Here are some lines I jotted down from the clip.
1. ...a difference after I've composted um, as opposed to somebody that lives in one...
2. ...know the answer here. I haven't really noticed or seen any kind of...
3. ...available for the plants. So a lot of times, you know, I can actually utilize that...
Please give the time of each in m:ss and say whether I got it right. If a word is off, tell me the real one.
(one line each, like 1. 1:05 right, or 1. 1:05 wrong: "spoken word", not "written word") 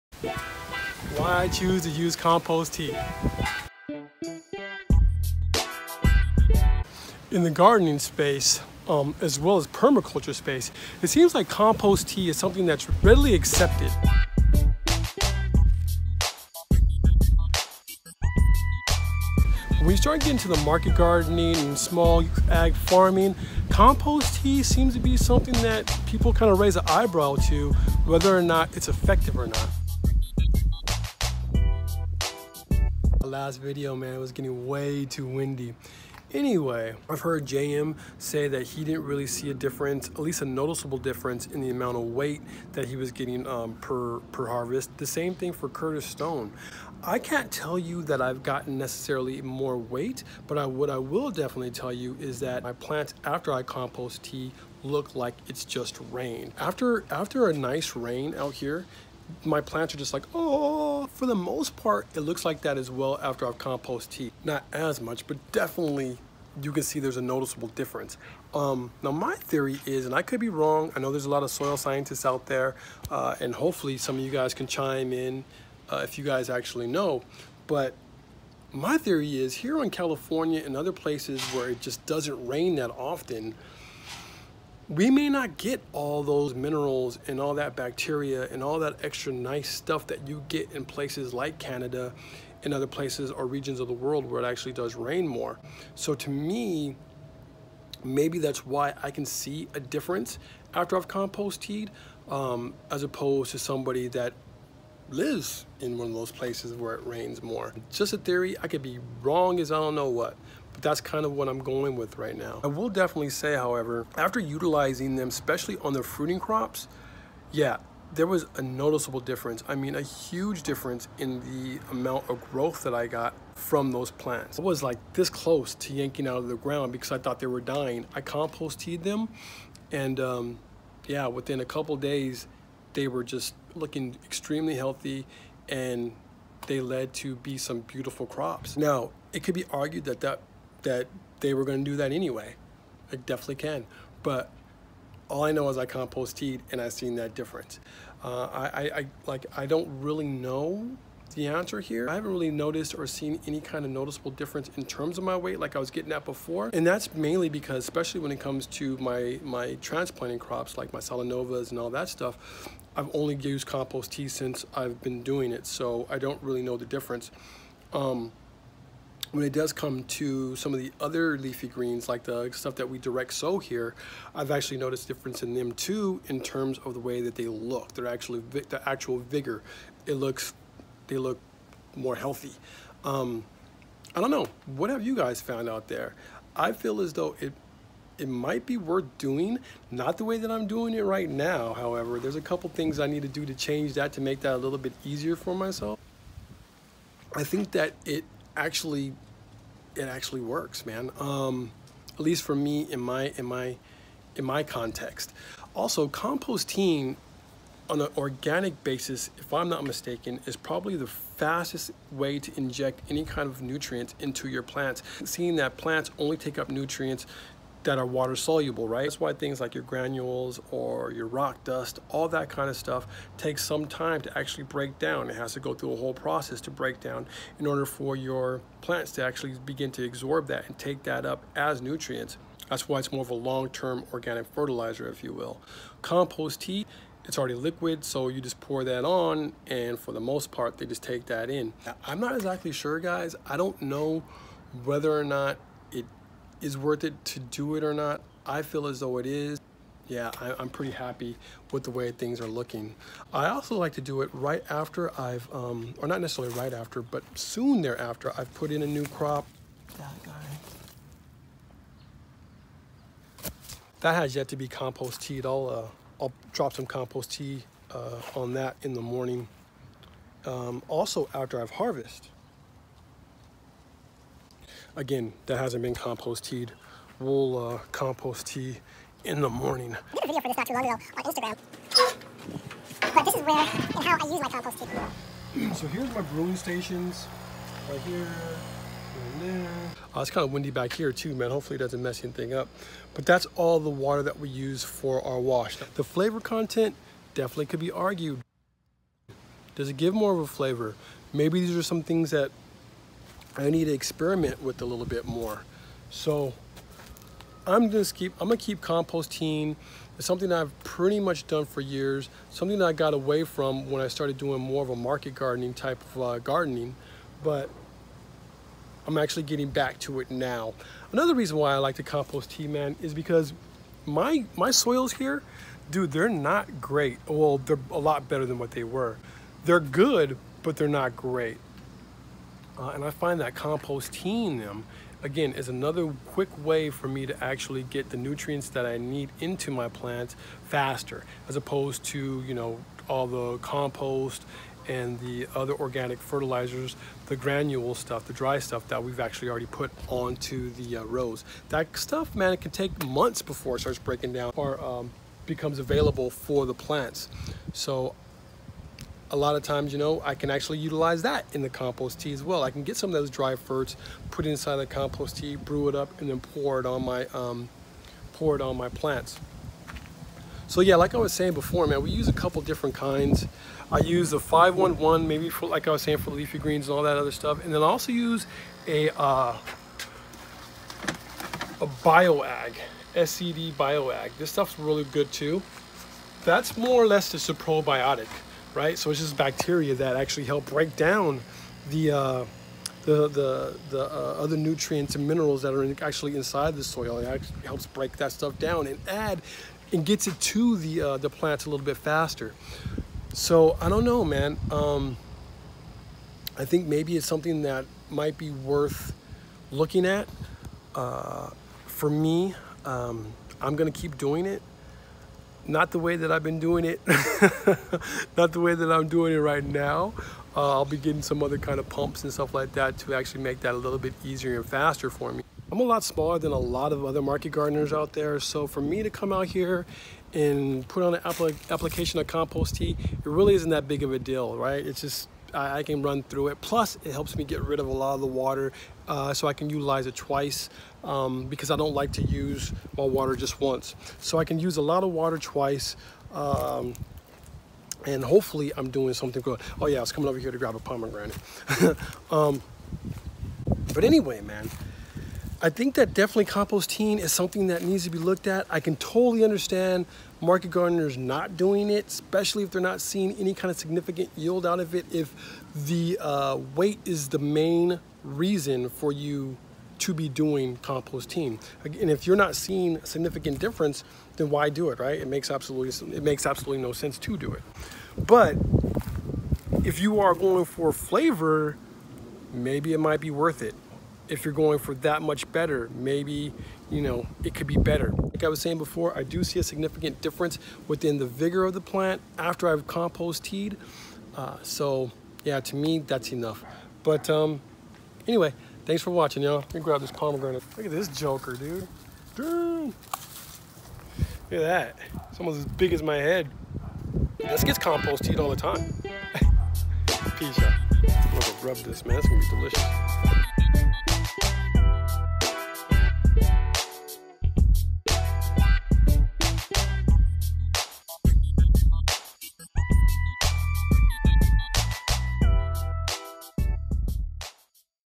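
1. 1:39 right
2. 2:30 right
3. 5:55 right.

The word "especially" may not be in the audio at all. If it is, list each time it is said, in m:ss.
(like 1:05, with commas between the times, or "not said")
1:55, 2:37, 7:42.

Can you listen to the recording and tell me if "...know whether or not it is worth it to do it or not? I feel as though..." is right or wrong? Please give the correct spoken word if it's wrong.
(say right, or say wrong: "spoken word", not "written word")
right.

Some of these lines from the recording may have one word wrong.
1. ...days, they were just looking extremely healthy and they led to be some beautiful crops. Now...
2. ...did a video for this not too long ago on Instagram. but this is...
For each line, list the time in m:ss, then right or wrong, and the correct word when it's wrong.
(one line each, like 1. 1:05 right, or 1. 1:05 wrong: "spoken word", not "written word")
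1. 2:11 right
2. 4:40 right.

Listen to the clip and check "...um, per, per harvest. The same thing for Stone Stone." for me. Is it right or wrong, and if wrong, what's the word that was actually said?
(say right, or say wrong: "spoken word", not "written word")
wrong: "Curtis", not "Stone".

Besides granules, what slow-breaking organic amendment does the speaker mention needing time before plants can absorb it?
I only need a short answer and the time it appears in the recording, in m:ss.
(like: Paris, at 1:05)
rock dust, at 3:41.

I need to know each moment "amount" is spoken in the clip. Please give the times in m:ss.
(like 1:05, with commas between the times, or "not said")
0:41, 2:01.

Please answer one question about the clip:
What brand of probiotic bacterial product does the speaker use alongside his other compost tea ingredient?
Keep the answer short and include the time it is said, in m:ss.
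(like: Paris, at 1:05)
SCD bioag, at 6:23.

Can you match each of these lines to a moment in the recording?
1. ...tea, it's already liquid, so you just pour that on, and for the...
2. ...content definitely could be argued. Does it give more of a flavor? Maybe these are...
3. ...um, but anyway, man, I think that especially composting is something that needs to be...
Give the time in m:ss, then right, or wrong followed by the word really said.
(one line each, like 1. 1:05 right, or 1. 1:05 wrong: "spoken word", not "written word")
1. 3:56 right
2. 4:56 right
3. 7:32 wrong: "definitely", not "especially".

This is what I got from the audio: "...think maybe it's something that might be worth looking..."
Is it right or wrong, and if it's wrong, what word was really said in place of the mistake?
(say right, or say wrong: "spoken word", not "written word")
right.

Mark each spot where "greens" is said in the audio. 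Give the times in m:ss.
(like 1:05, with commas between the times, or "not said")
2:51, 6:16.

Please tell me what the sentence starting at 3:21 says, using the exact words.
Um, at least for me in my in my in my context.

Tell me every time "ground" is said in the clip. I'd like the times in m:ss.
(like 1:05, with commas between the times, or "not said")
2:06.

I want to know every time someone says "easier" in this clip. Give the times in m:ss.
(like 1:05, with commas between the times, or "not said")
3:15, 7:04.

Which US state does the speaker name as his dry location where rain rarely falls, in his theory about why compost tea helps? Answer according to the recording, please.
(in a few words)
California.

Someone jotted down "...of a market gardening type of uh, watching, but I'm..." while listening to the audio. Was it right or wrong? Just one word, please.
wrong.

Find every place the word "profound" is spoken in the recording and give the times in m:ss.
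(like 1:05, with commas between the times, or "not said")
not said.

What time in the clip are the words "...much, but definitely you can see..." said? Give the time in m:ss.
1:04.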